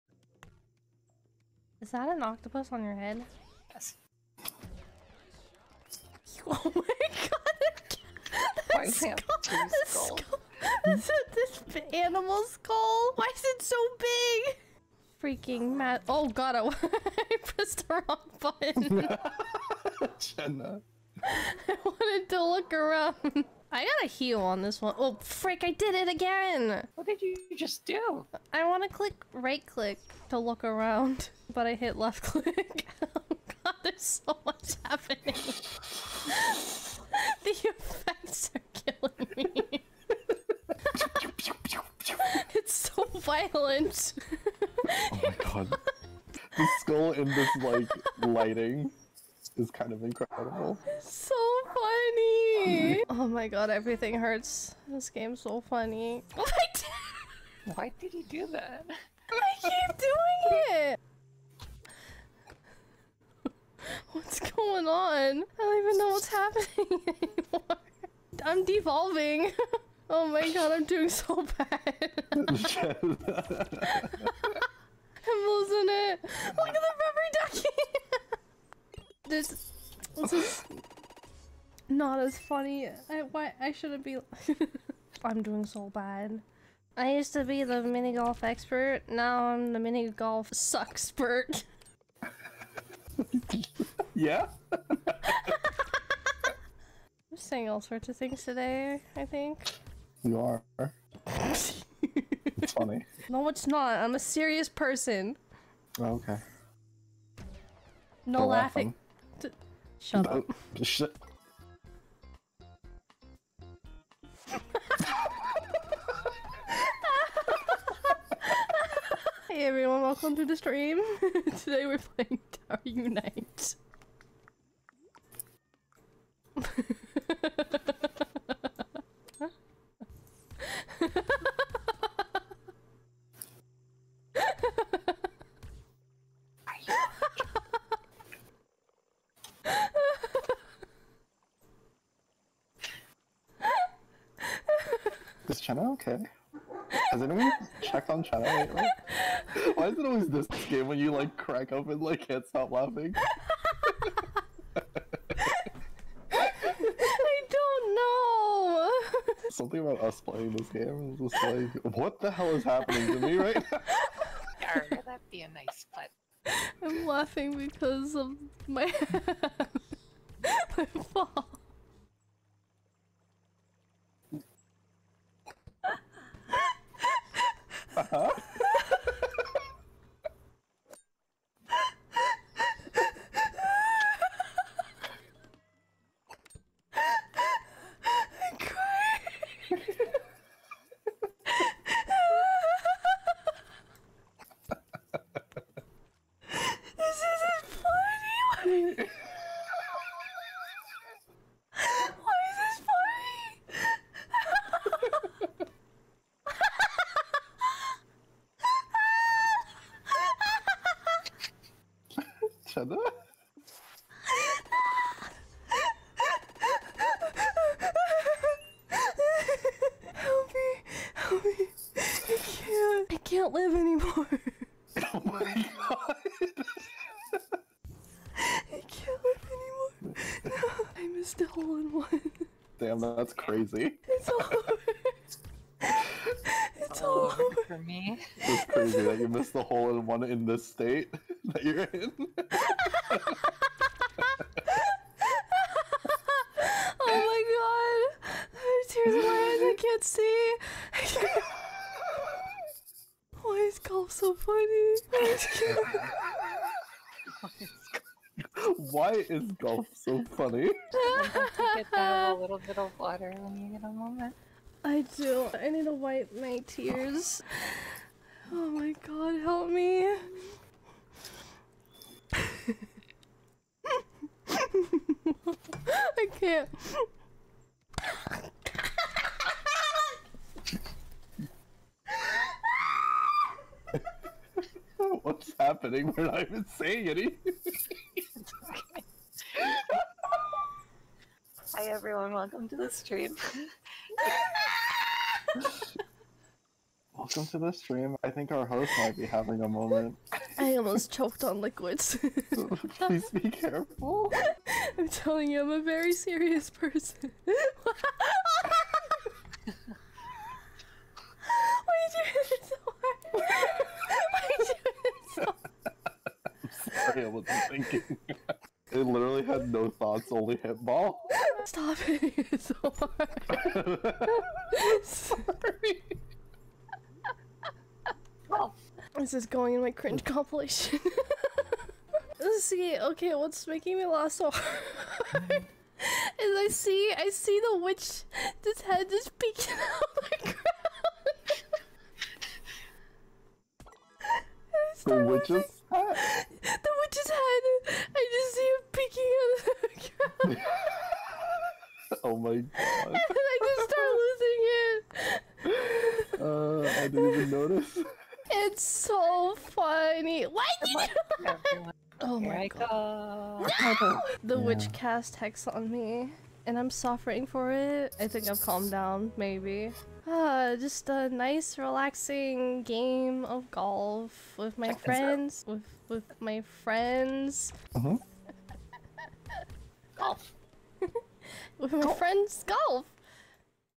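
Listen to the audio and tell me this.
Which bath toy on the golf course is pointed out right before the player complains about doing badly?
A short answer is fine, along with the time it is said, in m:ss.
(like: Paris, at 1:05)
rubber ducky, at 1:16.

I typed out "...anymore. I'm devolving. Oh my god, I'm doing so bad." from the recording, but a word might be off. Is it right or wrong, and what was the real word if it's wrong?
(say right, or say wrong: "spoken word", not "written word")
right.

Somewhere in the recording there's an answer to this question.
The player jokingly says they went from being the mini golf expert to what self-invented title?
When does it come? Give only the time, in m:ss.
1:29.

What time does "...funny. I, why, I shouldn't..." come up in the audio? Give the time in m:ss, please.
1:22.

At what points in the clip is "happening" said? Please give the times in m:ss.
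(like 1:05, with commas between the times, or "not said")
0:34, 1:06, 2:42, 4:45.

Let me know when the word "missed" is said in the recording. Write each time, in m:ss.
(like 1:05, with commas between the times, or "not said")
3:51, 3:59.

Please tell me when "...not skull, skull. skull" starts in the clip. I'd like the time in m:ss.
0:09.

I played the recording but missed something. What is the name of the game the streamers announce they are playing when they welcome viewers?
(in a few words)
Tower Unite.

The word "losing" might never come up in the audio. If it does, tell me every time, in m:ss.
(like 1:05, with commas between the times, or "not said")
1:12, 5:56.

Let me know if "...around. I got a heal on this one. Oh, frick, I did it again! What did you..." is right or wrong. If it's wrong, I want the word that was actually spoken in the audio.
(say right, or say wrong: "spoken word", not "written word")
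right.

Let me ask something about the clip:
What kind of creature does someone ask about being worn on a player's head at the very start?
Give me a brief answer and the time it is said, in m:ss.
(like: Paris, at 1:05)
octopus, at 0:02.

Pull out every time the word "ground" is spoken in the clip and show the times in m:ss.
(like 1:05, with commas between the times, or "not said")
5:40, 5:50.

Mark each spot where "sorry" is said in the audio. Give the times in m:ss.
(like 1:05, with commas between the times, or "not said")
5:17, 5:25.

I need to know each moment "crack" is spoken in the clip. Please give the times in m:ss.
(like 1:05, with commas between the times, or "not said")
2:31.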